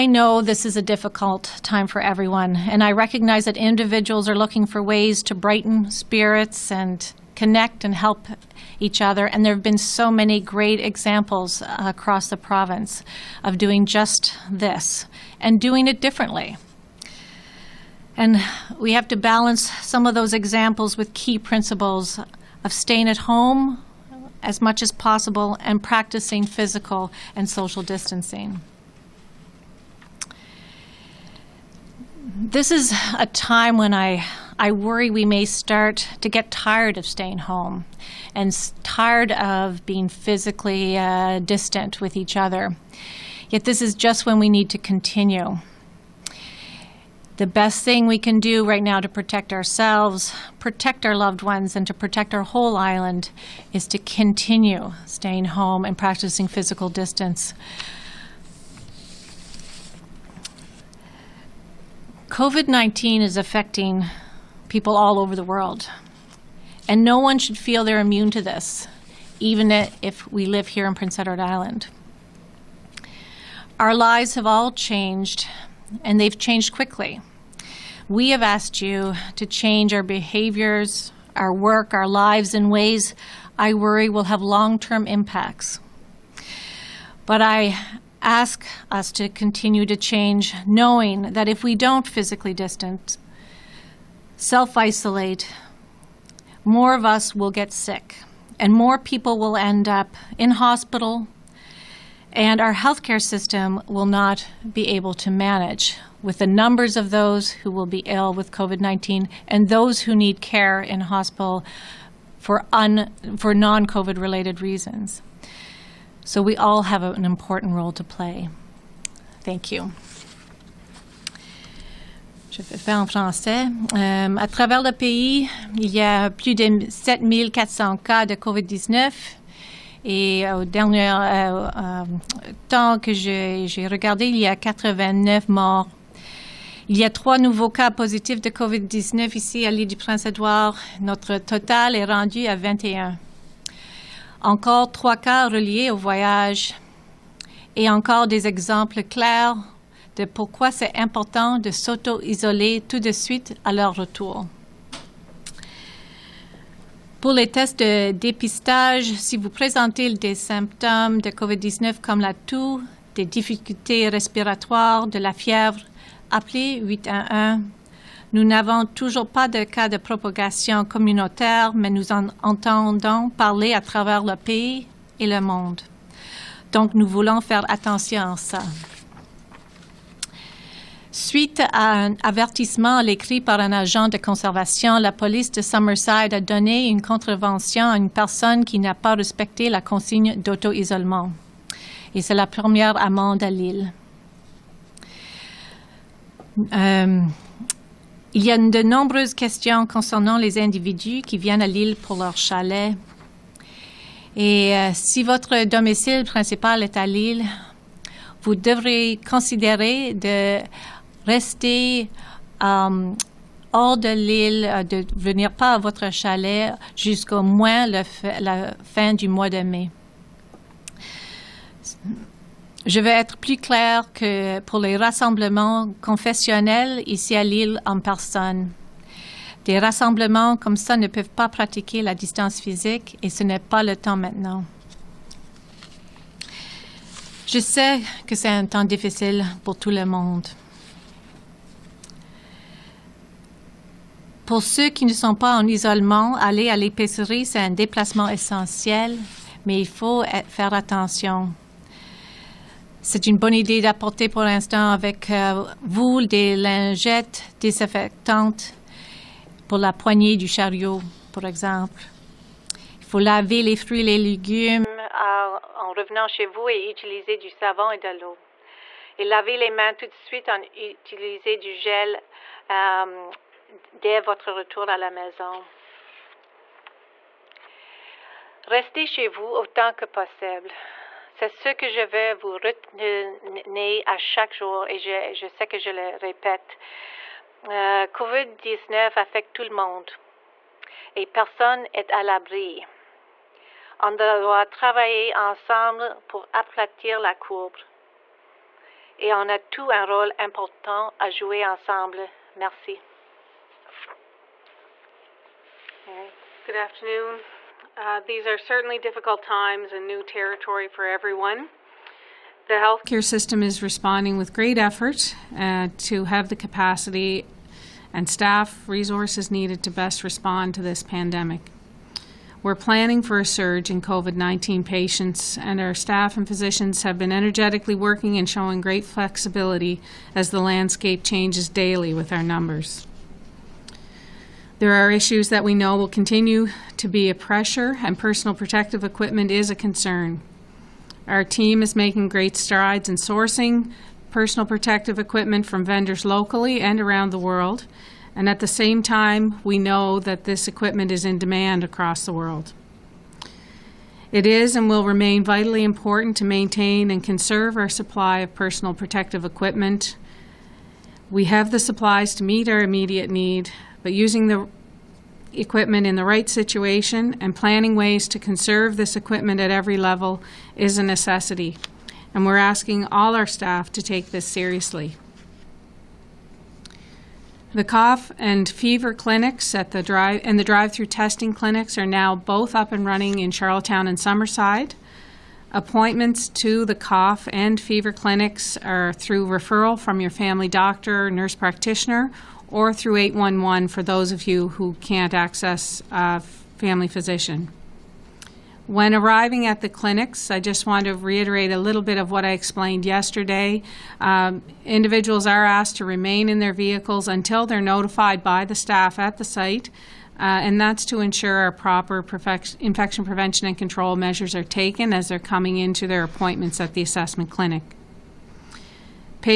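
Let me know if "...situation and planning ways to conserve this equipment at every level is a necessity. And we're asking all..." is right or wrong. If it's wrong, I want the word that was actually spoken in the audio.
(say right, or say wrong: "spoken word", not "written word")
right.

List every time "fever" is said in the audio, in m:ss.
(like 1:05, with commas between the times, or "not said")
6:18, 6:27.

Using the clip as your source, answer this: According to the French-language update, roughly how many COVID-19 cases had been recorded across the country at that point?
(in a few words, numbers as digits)
7,400.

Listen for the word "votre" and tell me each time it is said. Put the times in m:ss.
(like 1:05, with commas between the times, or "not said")
3:25, 3:35, 4:34.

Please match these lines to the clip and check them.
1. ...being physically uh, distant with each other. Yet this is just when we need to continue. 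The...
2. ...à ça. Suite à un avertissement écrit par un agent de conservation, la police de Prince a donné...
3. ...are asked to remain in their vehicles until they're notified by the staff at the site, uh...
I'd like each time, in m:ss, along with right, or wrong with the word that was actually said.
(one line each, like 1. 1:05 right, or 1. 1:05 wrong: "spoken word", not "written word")
1. 0:39 right
2. 2:58 wrong: "Summerside", not "Prince"
3. 6:45 right.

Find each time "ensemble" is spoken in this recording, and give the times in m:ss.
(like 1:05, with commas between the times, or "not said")
4:55, 5:01.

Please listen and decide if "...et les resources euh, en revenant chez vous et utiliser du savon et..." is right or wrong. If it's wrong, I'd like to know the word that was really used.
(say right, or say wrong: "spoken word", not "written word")
wrong: "légumes", not "resources".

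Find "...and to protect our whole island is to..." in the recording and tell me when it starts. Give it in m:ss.
0:51.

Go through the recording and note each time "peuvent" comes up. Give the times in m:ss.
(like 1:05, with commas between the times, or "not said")
3:51.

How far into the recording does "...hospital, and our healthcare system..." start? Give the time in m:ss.
1:40.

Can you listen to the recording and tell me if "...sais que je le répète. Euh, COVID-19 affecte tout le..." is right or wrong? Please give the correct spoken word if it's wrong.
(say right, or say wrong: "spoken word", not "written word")
right.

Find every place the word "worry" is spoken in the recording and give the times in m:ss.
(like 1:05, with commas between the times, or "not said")
0:34, 1:23.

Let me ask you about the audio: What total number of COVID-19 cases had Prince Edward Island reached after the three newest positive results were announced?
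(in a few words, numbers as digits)
21.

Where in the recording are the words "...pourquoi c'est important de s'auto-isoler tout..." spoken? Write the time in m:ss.
2:30.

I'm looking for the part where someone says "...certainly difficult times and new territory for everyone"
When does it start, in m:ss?
5:08.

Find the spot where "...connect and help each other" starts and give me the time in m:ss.
0:07.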